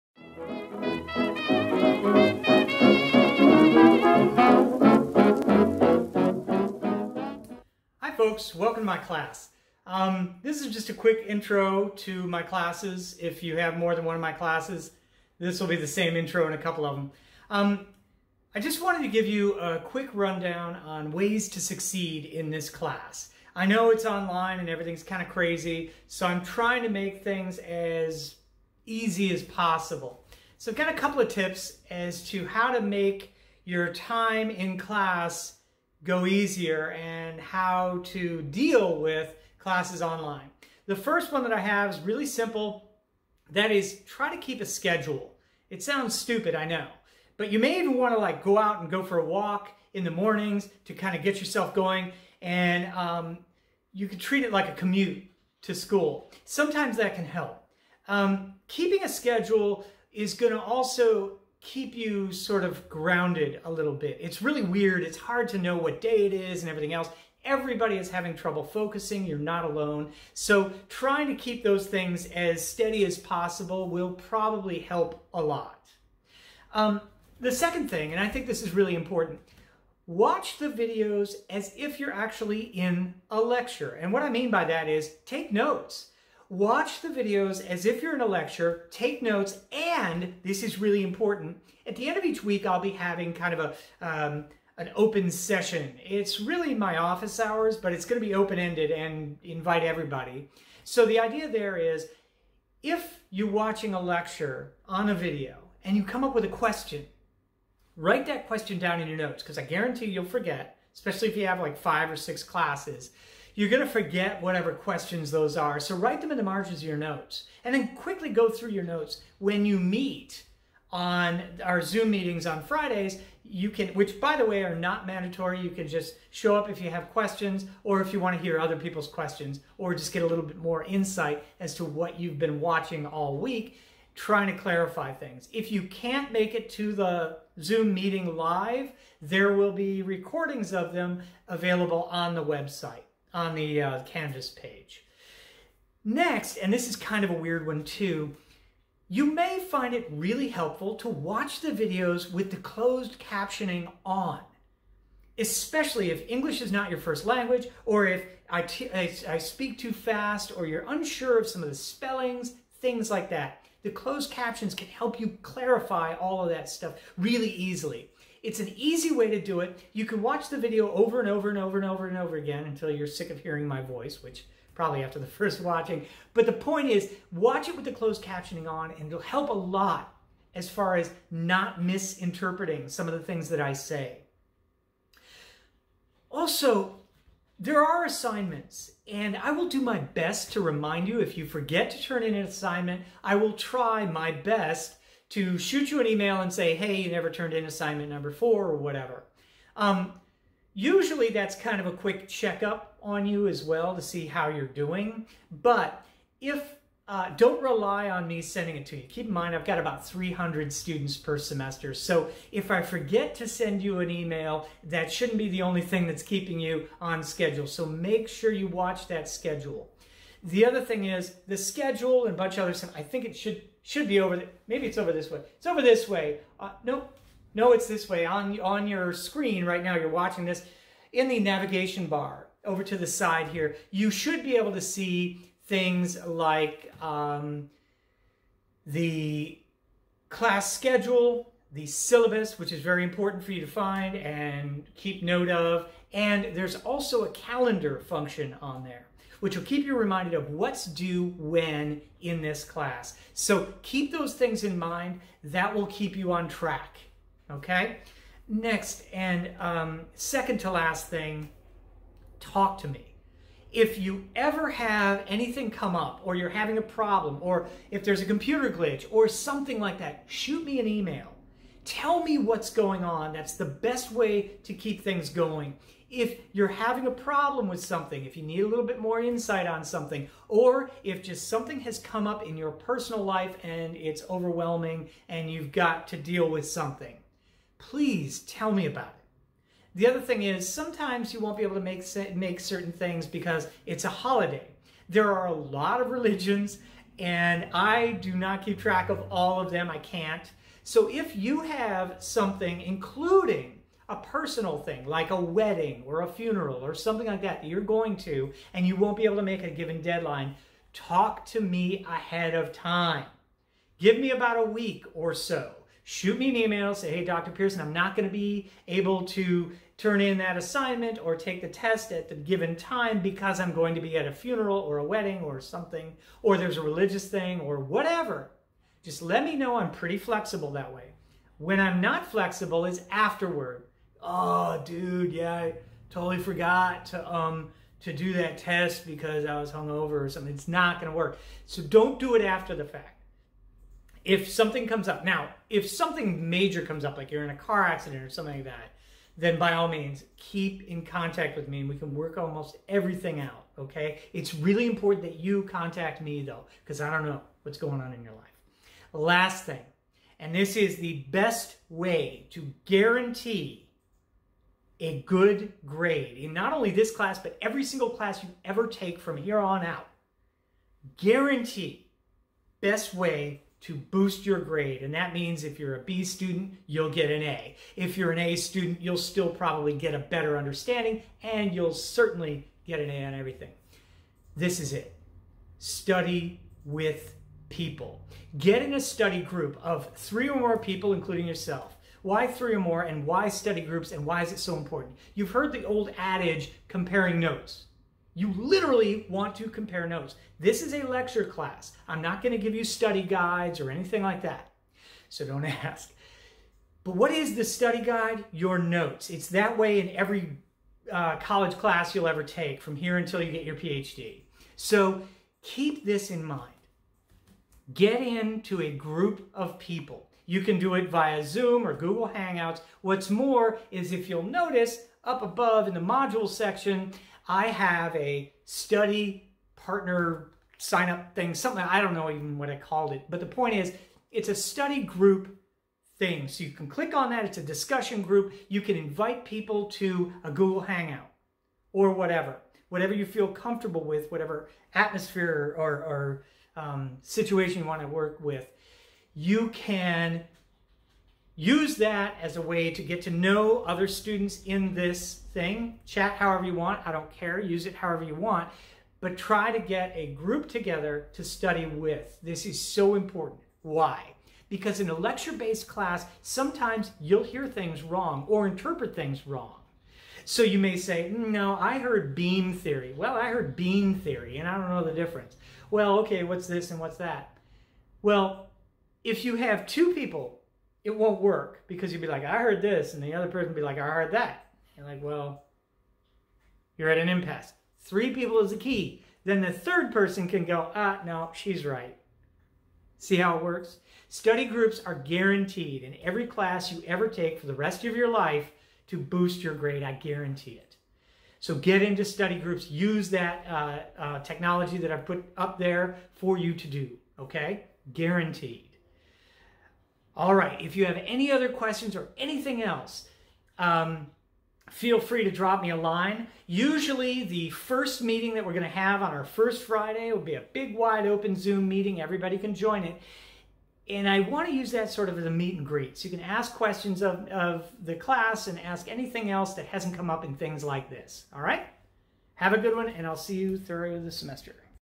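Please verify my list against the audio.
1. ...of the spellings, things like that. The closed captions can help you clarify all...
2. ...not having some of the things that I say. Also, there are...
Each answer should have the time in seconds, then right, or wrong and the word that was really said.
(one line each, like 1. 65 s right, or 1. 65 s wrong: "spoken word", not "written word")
1. 161 s right
2. 181 s wrong: "misinterpreting", not "having".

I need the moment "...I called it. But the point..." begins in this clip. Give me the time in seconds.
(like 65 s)
432 s.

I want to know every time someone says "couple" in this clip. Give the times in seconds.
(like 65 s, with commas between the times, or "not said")
16 s, 30 s.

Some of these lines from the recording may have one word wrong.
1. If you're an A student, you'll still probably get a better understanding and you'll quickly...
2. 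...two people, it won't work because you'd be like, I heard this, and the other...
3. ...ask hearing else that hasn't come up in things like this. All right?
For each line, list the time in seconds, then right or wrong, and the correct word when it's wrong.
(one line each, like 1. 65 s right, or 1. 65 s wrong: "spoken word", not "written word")
1. 377 s wrong: "certainly", not "quickly"
2. 479 s right
3. 528 s wrong: "anything", not "hearing".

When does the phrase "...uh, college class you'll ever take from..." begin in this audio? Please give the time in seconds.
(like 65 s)
411 s.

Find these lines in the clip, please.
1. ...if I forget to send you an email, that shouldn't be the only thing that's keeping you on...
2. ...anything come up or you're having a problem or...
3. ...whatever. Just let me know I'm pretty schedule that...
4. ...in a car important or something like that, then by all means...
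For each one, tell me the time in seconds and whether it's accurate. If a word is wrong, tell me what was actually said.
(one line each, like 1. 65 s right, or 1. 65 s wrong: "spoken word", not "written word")
1. 212 s right
2. 265 s right
3. 327 s wrong: "flexible", not "schedule"
4. 347 s wrong: "accident", not "important".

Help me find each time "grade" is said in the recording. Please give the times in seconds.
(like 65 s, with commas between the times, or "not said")
365 s, 374 s, 499 s.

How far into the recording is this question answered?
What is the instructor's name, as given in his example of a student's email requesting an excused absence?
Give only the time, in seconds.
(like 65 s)
317 s.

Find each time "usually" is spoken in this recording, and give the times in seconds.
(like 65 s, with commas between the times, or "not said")
200 s, 516 s.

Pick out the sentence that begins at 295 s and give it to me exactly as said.
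There are a lot of religions and I do not keep track of all of them.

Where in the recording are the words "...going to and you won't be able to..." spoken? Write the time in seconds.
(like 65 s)
307 s.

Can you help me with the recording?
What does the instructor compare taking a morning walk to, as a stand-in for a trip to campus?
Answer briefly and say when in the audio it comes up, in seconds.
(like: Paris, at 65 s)
a commute to school, at 54 s.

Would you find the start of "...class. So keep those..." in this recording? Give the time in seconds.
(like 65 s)
252 s.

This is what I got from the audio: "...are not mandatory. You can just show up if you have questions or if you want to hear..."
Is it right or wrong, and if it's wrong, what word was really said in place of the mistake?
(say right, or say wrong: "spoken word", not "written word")
right.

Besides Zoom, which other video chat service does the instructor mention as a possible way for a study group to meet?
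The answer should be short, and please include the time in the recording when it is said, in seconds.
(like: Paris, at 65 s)
Google Hangouts, at 421 s.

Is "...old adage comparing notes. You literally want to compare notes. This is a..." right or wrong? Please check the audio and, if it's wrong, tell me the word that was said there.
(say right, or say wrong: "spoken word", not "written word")
right.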